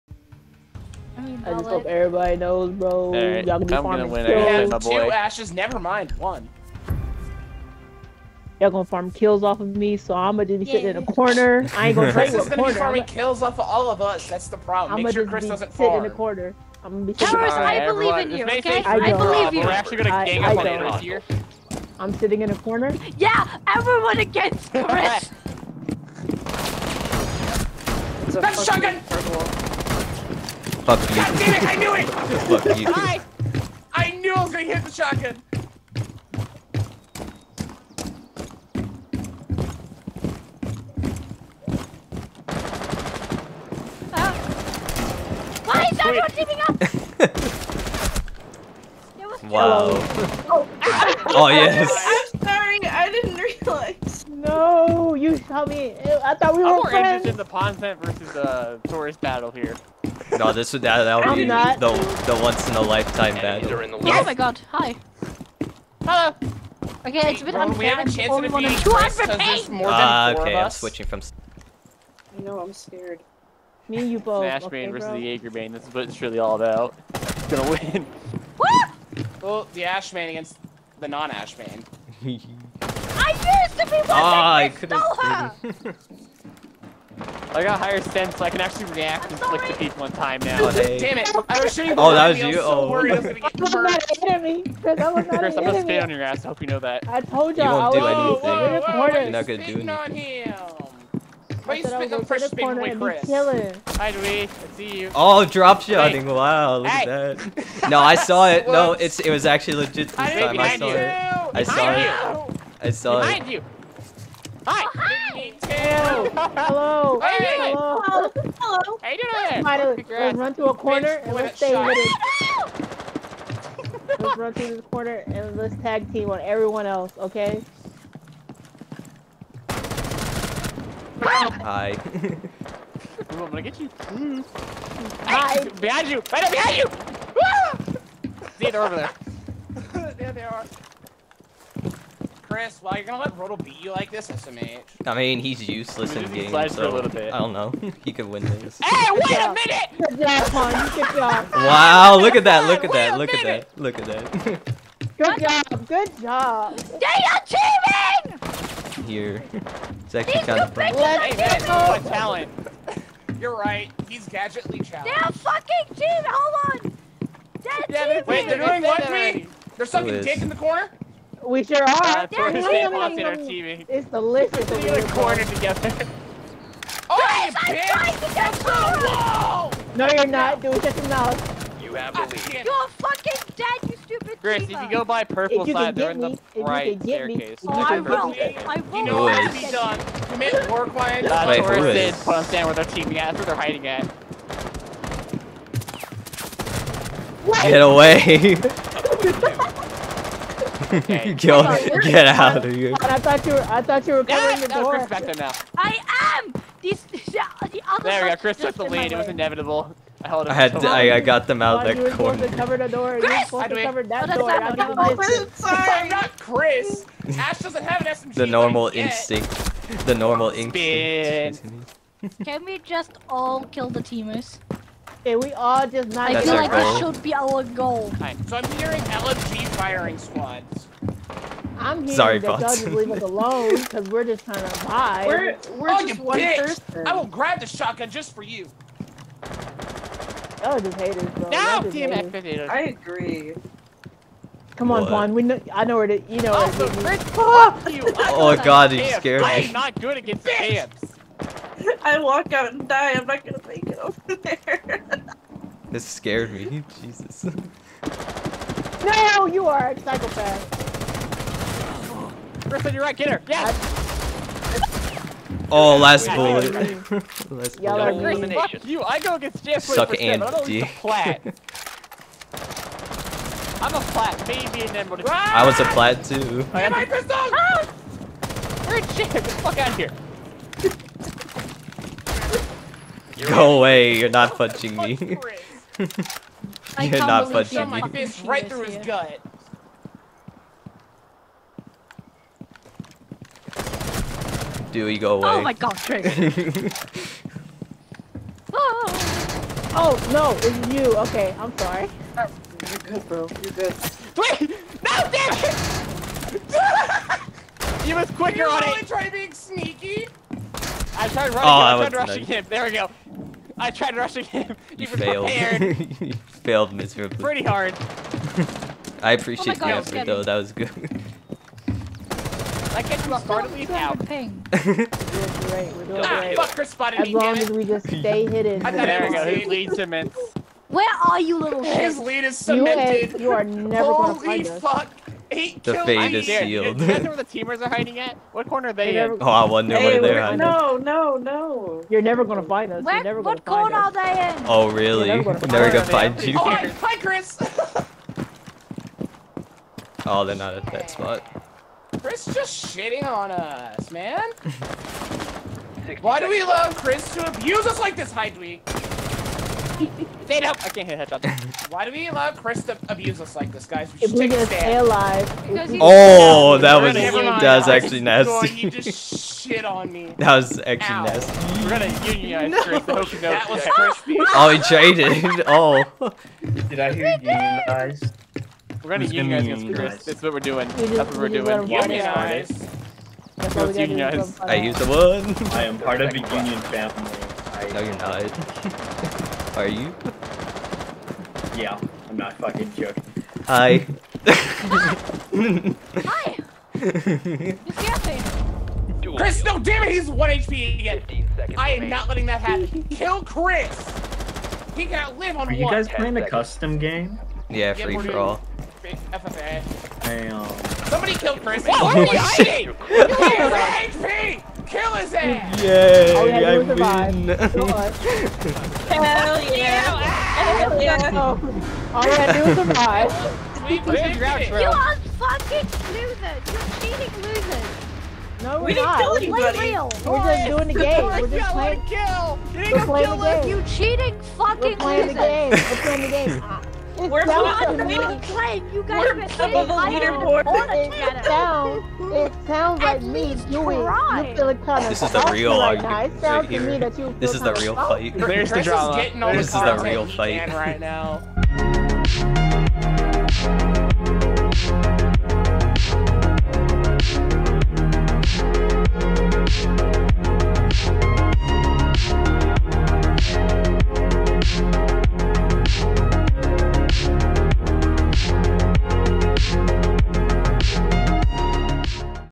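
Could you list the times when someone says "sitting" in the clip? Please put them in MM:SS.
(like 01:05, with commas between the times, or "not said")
00:10, 00:17, 00:22.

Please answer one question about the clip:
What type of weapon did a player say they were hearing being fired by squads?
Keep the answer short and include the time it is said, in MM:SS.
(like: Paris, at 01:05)
LMG, at 03:49.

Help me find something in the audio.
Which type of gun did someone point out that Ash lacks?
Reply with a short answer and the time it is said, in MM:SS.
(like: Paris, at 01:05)
SMG, at 03:38.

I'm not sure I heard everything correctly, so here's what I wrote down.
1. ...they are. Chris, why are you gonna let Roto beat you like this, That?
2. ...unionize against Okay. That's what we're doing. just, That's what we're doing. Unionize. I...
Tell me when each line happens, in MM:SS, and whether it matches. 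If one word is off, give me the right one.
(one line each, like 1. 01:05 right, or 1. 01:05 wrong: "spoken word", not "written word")
1. 02:20 wrong: "SMH", not "That"
2. 06:19 wrong: "Chris", not "Okay".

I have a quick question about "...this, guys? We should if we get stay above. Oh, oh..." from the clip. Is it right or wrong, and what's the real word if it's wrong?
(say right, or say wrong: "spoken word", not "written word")
wrong: "alive", not "above".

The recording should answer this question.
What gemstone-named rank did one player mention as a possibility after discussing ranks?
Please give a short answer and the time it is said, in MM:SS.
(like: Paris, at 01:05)
Emerald, at 04:34.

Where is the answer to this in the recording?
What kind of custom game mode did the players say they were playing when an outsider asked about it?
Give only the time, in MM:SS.
06:47.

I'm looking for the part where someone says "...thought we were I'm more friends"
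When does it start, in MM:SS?
00:56.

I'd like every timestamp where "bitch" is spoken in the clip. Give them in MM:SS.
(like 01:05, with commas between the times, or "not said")
02:57, 03:56.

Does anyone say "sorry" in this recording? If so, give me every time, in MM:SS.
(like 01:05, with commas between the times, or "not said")
03:52, 05:01.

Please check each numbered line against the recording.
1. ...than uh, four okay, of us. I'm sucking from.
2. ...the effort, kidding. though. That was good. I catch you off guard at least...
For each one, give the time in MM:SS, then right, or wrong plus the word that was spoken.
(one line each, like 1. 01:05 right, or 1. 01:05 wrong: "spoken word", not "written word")
1. 01:09 wrong: "switching", not "sucking"
2. 05:19 right.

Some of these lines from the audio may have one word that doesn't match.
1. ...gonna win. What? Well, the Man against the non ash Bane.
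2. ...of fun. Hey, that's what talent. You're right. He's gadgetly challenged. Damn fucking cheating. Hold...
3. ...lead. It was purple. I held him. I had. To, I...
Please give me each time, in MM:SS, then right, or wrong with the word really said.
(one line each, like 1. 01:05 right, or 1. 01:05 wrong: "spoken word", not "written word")
1. 01:17 right
2. 02:40 right
3. 03:28 wrong: "inevitable", not "purple".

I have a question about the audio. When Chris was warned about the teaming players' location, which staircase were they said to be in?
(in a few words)
The right staircase.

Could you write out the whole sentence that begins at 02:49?
They're sucking dick in the corner.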